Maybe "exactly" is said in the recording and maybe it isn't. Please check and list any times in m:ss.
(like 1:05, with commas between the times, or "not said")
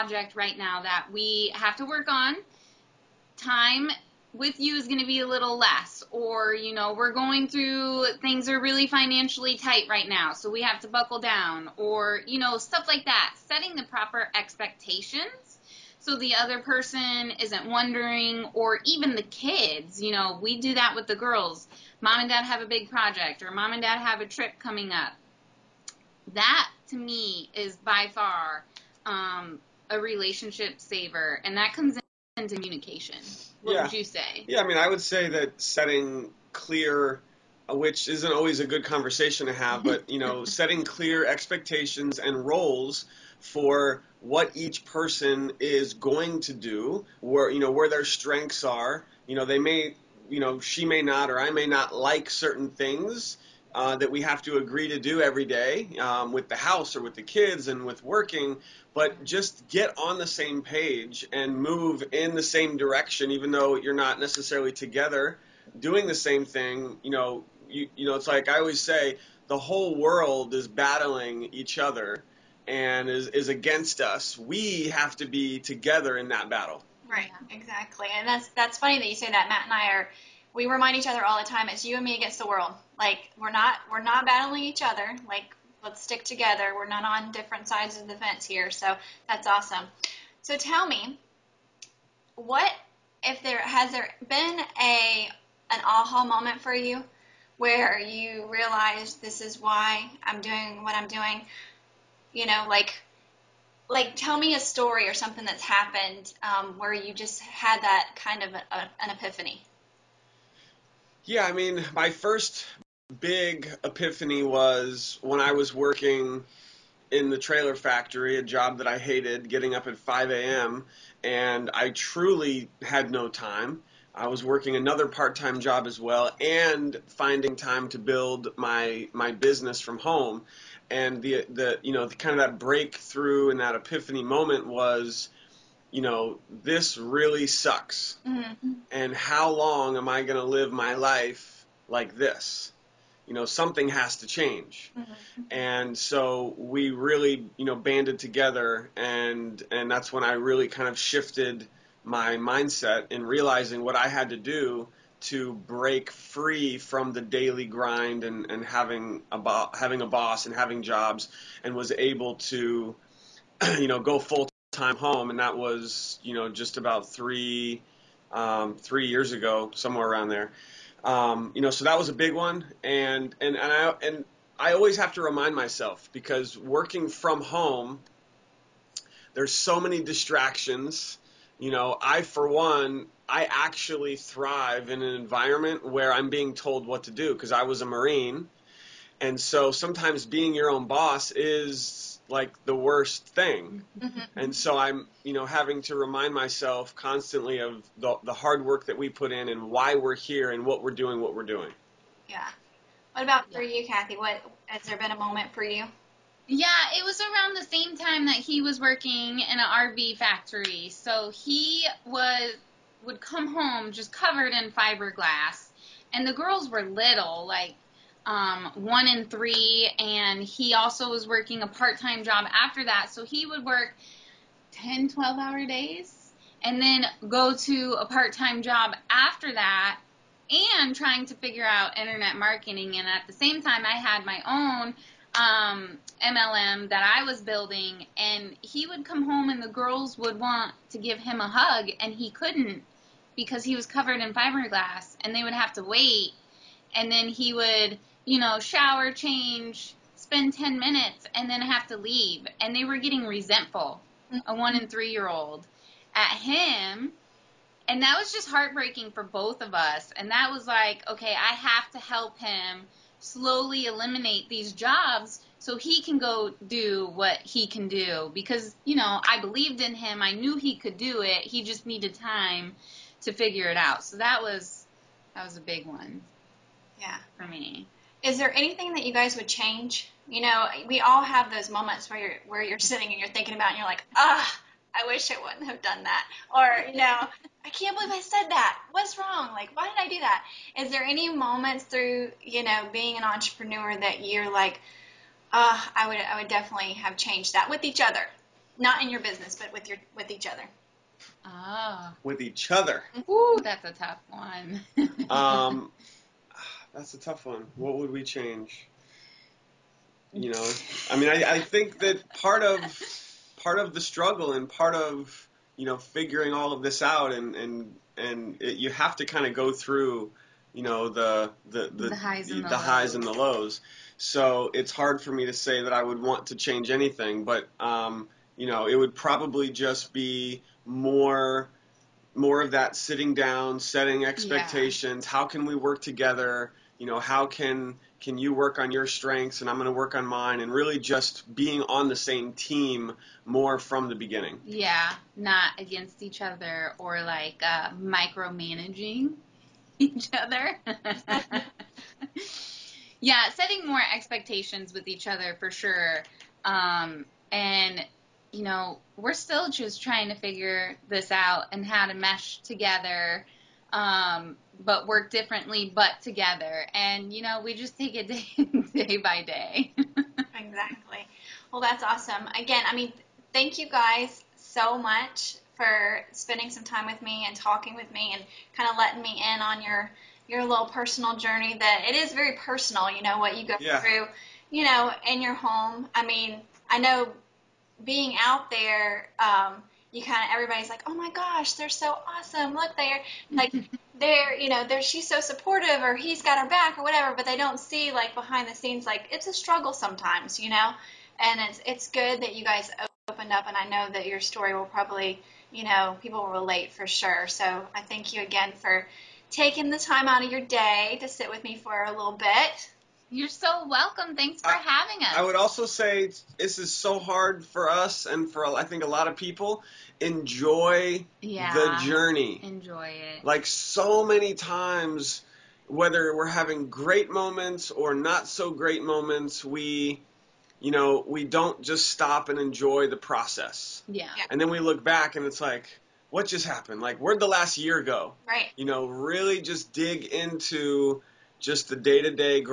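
1:17, 6:09.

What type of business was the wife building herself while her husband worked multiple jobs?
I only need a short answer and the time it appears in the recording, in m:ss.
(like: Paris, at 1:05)
MLM, at 3:56.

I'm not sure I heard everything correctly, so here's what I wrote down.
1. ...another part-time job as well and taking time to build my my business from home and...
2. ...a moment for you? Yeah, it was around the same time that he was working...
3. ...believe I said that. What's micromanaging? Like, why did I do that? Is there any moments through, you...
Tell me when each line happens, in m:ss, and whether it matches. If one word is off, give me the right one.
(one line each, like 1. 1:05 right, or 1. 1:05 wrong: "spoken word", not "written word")
1. 2:04 wrong: "finding", not "taking"
2. 3:25 right
3. 4:47 wrong: "wrong", not "micromanaging".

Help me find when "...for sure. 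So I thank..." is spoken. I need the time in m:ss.
6:46.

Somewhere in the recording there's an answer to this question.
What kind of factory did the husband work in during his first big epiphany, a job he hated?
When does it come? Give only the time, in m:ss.
1:57.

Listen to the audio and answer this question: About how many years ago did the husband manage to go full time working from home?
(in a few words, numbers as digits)
3 years.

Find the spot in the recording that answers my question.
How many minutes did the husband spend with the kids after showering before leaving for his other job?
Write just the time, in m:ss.
4:10.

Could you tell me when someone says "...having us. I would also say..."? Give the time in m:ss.
6:54.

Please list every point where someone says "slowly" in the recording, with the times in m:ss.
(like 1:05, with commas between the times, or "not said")
4:23.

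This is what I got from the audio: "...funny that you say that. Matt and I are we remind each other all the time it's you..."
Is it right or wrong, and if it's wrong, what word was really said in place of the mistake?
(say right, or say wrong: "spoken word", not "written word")
right.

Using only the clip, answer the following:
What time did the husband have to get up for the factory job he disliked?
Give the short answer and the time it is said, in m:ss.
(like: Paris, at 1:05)
5 a.m., at 1:59.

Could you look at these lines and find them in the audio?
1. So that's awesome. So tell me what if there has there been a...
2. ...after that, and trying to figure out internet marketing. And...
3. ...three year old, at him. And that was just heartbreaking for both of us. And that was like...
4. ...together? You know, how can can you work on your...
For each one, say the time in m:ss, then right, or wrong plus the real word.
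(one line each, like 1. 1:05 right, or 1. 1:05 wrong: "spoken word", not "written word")
1. 1:28 right
2. 3:49 right
3. 4:14 right
4. 5:36 right.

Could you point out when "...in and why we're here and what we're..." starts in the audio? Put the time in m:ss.
3:19.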